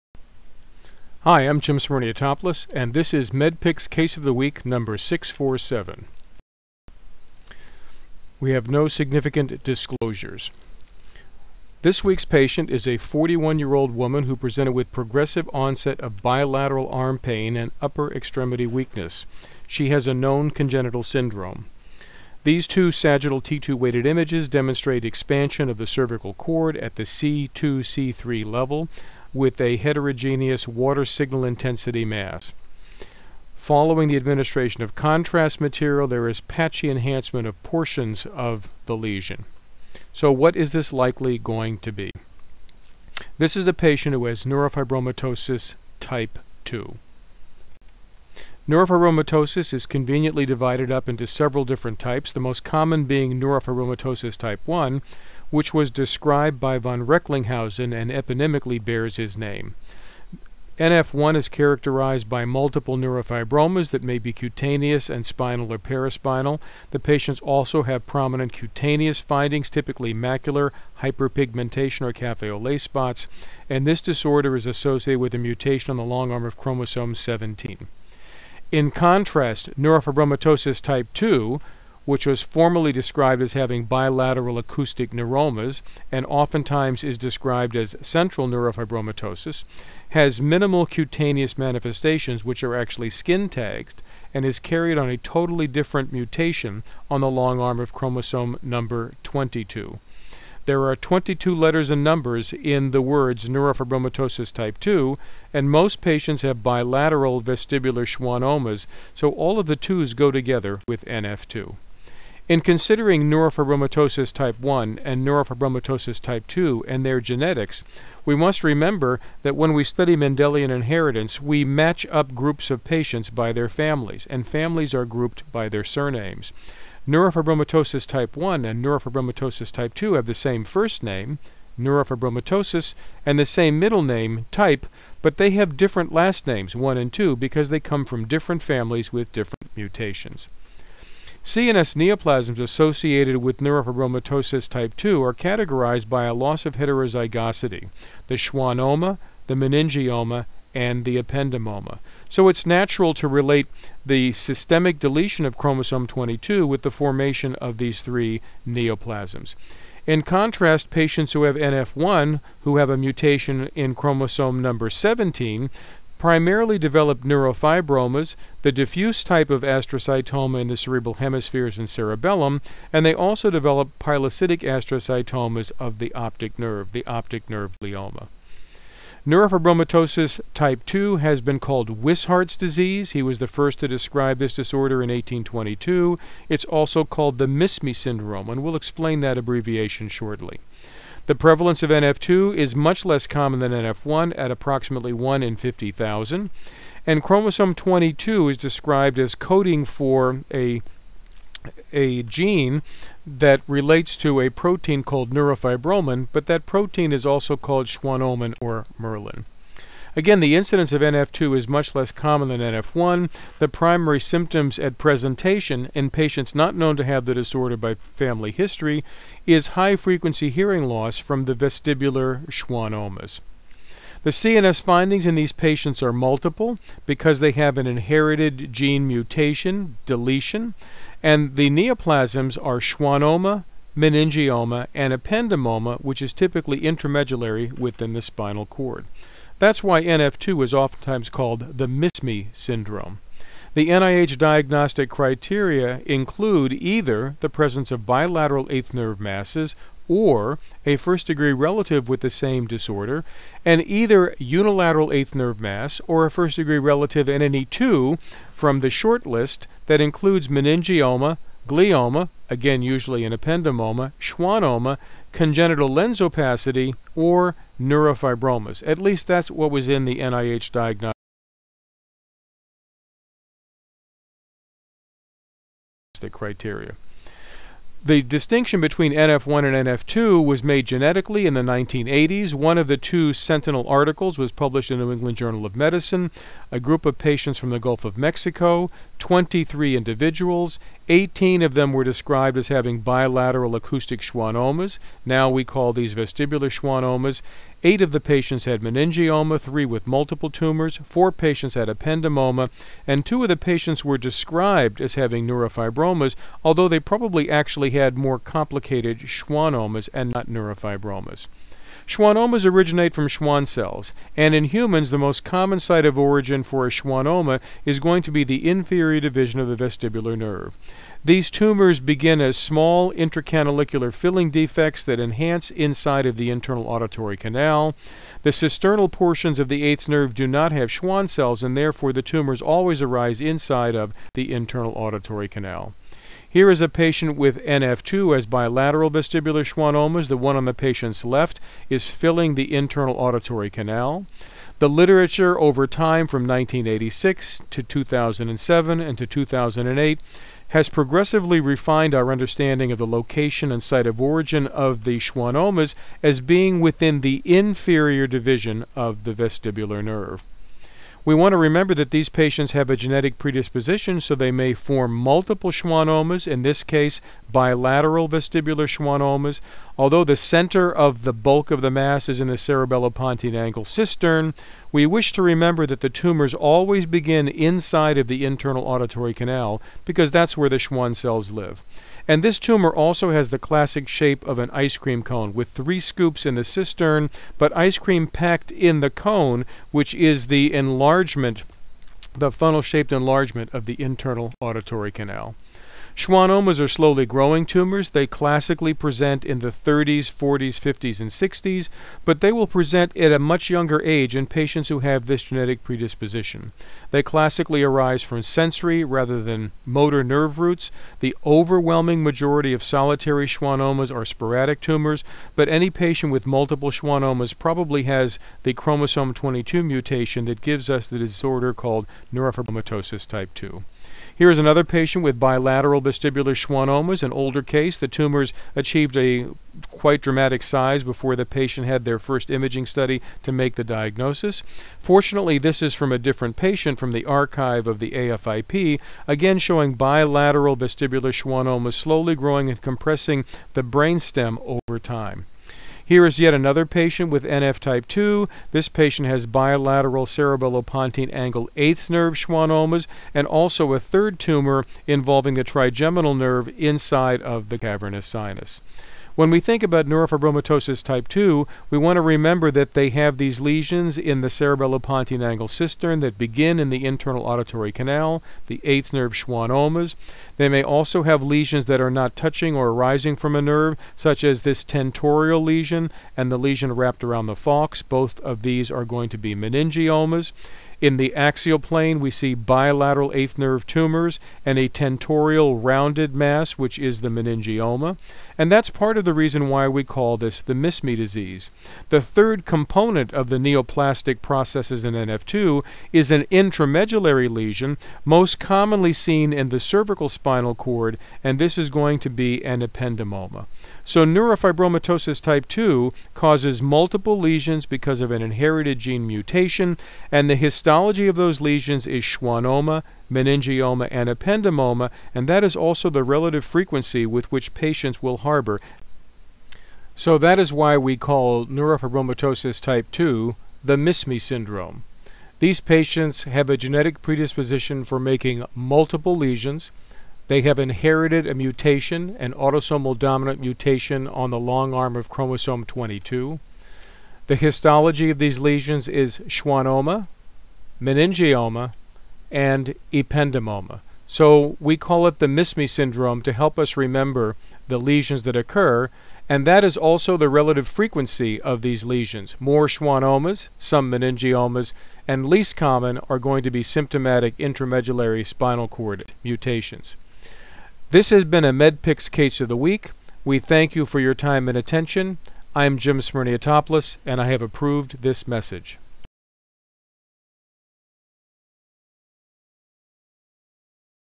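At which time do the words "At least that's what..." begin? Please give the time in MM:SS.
04:28.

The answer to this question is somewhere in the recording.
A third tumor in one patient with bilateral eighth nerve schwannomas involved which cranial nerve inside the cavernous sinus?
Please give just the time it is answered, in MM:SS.
07:35.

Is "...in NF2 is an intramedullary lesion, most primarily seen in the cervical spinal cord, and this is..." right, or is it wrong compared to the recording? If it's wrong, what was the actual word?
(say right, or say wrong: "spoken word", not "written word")
wrong: "commonly", not "primarily".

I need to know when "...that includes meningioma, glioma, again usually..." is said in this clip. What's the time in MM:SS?
04:19.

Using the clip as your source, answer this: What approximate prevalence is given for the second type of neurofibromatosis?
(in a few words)
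1 in 50,000.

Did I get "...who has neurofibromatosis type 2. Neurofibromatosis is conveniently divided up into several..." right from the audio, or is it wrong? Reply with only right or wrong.
right.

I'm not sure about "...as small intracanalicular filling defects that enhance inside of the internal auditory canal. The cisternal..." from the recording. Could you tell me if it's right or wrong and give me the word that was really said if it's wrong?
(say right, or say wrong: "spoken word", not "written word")
right.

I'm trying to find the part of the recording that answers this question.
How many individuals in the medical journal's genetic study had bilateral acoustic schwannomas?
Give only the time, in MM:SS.
04:51.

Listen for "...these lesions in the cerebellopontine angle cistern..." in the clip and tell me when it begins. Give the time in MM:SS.
07:43.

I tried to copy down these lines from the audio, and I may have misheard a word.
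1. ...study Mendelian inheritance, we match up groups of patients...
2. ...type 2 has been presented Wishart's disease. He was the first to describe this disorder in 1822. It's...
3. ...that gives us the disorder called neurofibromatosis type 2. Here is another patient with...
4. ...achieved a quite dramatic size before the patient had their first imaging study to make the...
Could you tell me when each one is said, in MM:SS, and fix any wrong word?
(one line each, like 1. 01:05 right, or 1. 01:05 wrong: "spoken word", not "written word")
1. 01:59 right
2. 03:00 wrong: "called", not "presented"
3. 07:00 right
4. 07:08 right.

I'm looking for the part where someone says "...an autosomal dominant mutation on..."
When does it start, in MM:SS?
08:52.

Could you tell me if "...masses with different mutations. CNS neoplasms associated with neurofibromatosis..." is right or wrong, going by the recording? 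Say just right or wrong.
wrong.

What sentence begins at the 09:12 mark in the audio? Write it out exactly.
More schwannomas, some meningiomas, and least common are going to be symptomatic intramedullary spinal cord mutations.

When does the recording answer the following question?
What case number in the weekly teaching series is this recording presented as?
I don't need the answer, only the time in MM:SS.
00:04.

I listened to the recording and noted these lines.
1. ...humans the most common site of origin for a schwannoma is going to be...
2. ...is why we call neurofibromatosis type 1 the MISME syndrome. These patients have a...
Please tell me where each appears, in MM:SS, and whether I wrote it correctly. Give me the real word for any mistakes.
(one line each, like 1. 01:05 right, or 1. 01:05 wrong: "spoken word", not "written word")
1. 05:14 right
2. 08:40 wrong: "2", not "1".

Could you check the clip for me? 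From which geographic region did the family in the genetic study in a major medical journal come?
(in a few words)
Gulf of Mexico.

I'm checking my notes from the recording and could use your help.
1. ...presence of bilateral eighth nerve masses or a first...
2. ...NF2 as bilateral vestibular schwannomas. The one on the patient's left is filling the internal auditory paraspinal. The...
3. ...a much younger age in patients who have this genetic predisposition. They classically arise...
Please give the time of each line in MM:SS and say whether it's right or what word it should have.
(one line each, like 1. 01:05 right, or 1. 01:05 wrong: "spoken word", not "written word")
1. 04:07 right
2. 05:37 wrong: "canal", not "paraspinal"
3. 06:43 right.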